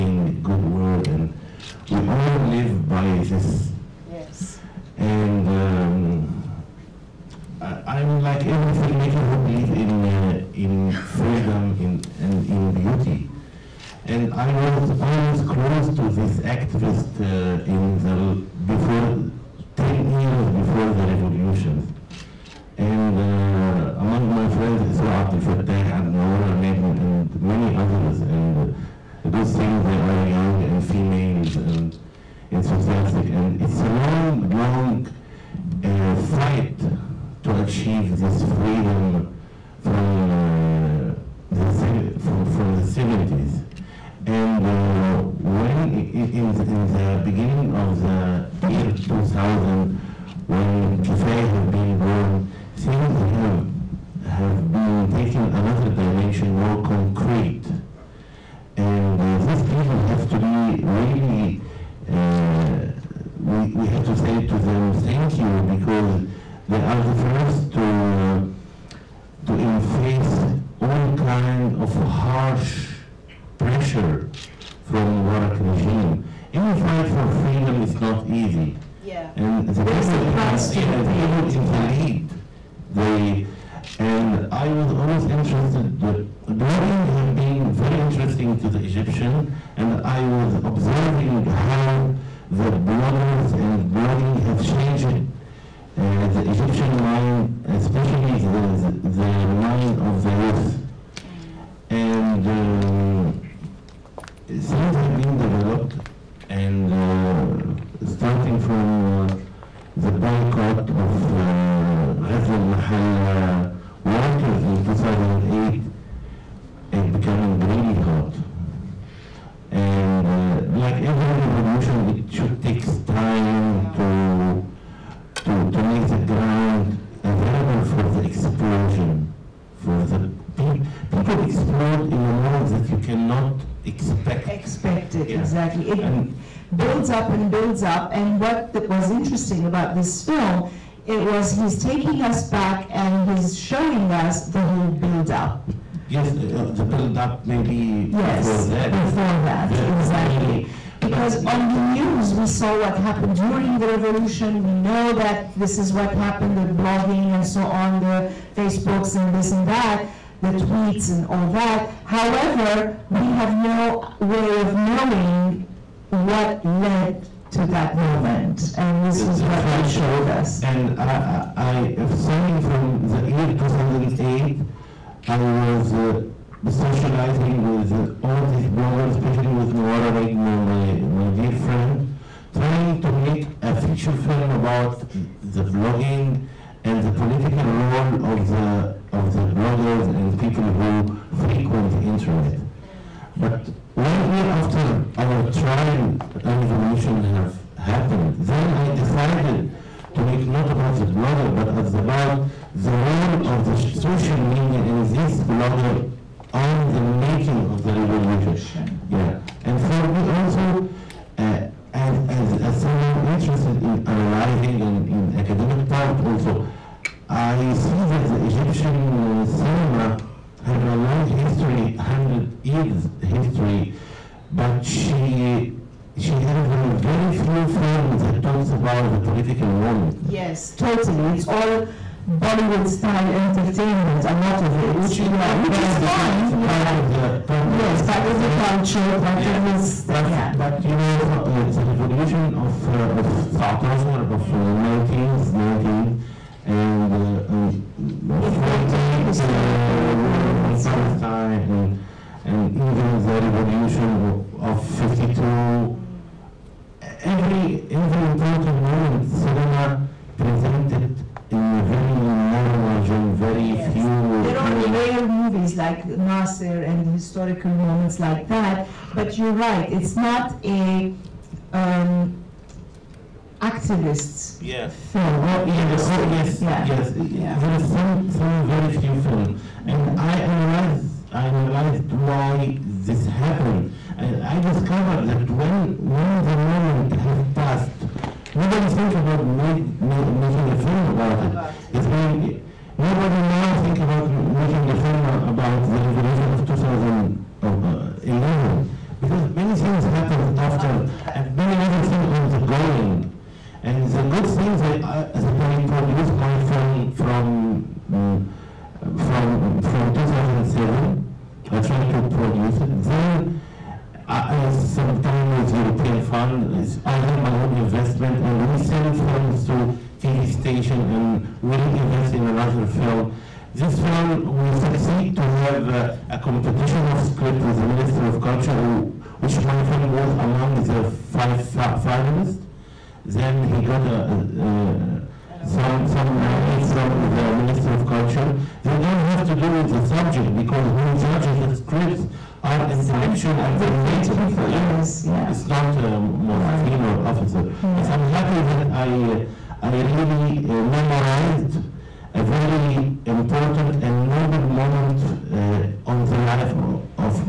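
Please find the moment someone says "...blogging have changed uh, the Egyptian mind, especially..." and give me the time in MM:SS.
01:33.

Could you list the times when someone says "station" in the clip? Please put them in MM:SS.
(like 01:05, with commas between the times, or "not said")
05:20.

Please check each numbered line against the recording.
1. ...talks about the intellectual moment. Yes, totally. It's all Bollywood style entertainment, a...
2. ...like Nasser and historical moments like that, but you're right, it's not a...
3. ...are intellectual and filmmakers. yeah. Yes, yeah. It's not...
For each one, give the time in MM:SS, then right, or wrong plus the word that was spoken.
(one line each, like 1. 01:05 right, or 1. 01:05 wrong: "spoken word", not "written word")
1. 03:48 wrong: "political", not "intellectual"
2. 04:25 right
3. 05:42 right.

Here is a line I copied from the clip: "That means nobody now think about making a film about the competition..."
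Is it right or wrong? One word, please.
wrong.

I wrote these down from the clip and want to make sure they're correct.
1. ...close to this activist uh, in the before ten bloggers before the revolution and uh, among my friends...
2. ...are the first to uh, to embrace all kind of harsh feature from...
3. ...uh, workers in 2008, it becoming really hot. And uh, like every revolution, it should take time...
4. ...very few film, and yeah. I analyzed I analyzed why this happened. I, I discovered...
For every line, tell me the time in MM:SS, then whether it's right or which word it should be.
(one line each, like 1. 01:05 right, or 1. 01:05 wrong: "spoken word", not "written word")
1. 00:15 wrong: "years", not "bloggers"
2. 01:06 wrong: "pressure", not "feature"
3. 01:53 right
4. 04:38 right.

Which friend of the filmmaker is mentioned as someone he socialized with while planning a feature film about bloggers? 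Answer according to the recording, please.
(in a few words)
Nawara Negm.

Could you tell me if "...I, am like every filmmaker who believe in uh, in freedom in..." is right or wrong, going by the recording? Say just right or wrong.
right.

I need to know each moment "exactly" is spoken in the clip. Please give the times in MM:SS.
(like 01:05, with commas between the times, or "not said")
02:15, 02:29.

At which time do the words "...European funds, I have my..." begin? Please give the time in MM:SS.
05:15.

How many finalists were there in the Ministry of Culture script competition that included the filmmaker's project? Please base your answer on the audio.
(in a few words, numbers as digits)
5.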